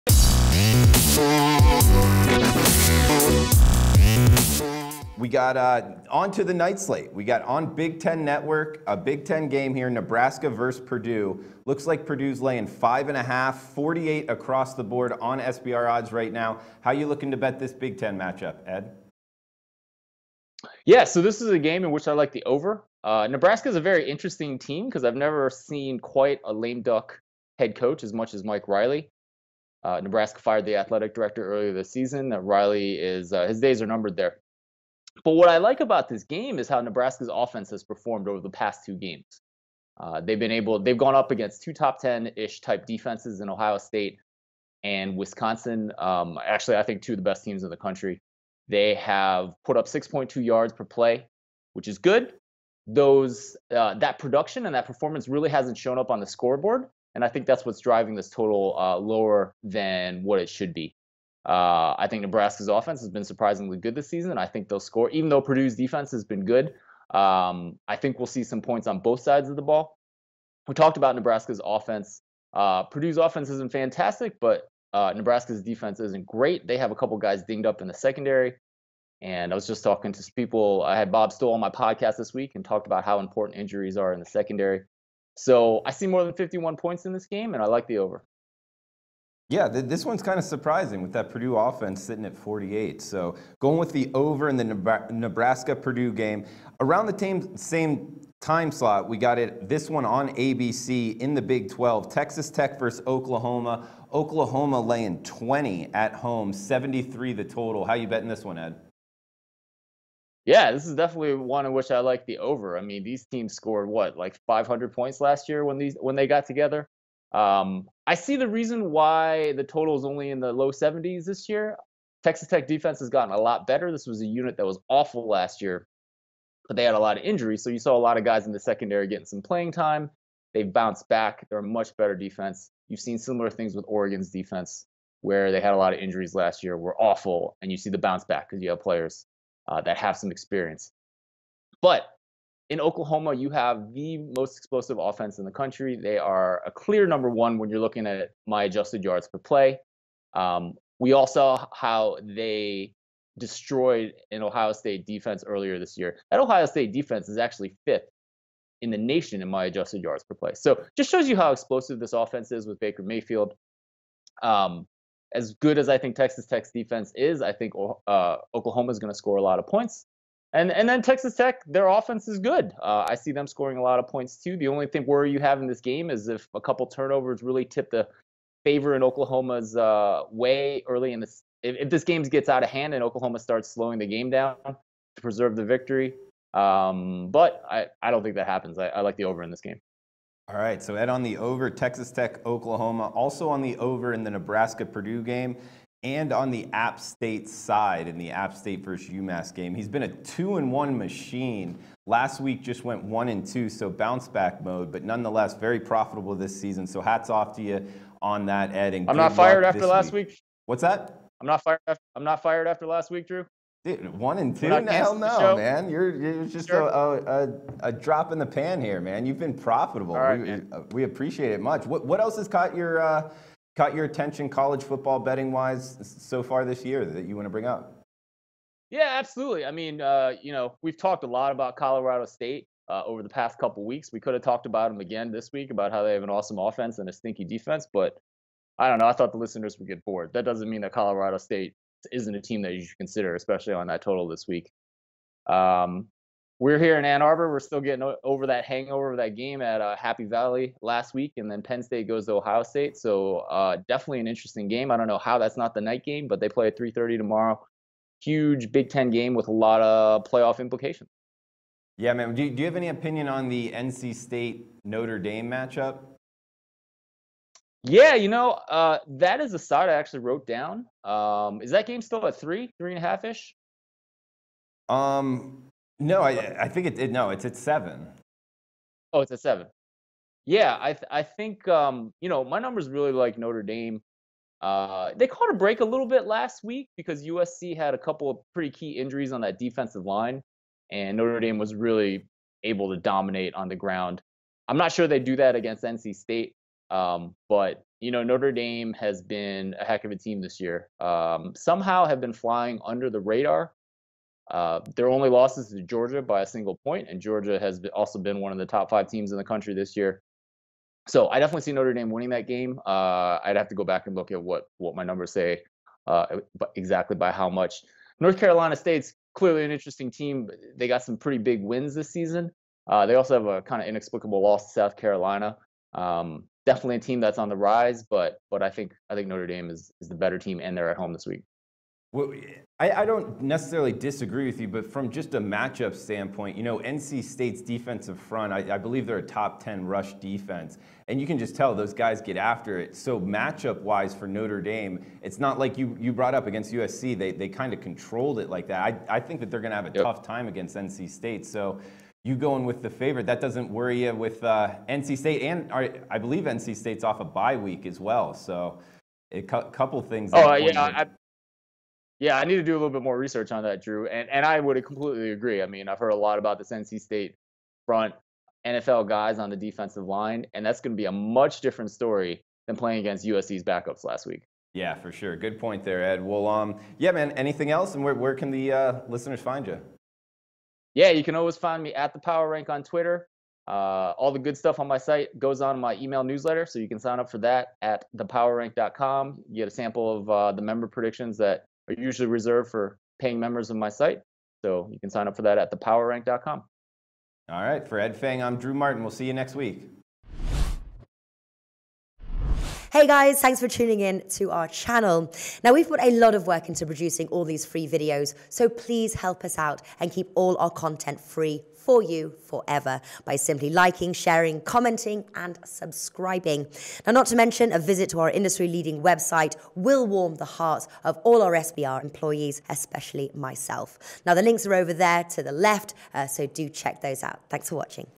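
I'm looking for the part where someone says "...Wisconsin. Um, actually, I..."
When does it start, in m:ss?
0:45.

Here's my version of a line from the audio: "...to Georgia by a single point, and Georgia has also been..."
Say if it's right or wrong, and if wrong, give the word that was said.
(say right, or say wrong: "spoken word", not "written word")
right.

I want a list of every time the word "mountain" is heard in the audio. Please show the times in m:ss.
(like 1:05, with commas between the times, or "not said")
not said.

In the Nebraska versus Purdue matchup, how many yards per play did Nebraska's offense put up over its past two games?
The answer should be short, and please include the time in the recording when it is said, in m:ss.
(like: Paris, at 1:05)
6.2, at 0:49.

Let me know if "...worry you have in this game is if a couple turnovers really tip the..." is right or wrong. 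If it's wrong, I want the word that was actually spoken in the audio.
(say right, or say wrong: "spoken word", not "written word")
right.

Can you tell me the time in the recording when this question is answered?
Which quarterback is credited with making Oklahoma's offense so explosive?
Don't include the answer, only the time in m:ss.
2:42.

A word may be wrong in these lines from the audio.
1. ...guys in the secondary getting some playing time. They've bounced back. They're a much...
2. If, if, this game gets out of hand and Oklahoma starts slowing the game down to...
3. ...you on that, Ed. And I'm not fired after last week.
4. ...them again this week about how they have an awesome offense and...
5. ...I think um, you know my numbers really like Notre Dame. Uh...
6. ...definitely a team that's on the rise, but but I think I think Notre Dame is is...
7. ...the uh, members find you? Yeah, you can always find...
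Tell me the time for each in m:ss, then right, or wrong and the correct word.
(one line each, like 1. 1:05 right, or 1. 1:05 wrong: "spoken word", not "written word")
1. 2:08 right
2. 3:01 right
3. 3:27 right
4. 3:54 right
5. 4:41 right
6. 5:26 right
7. 6:18 wrong: "listeners", not "members".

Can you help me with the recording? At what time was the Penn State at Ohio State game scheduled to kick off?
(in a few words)
3:30.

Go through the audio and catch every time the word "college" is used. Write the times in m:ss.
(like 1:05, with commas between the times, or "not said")
3:44.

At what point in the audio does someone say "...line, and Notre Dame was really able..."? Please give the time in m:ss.
4:50.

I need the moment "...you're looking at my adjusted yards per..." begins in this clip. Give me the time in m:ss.
2:27.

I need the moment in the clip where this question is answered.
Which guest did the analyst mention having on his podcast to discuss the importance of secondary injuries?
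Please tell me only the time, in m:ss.
1:21.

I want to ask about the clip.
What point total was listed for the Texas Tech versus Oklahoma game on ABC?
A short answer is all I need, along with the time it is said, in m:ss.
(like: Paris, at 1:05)
73, at 1:46.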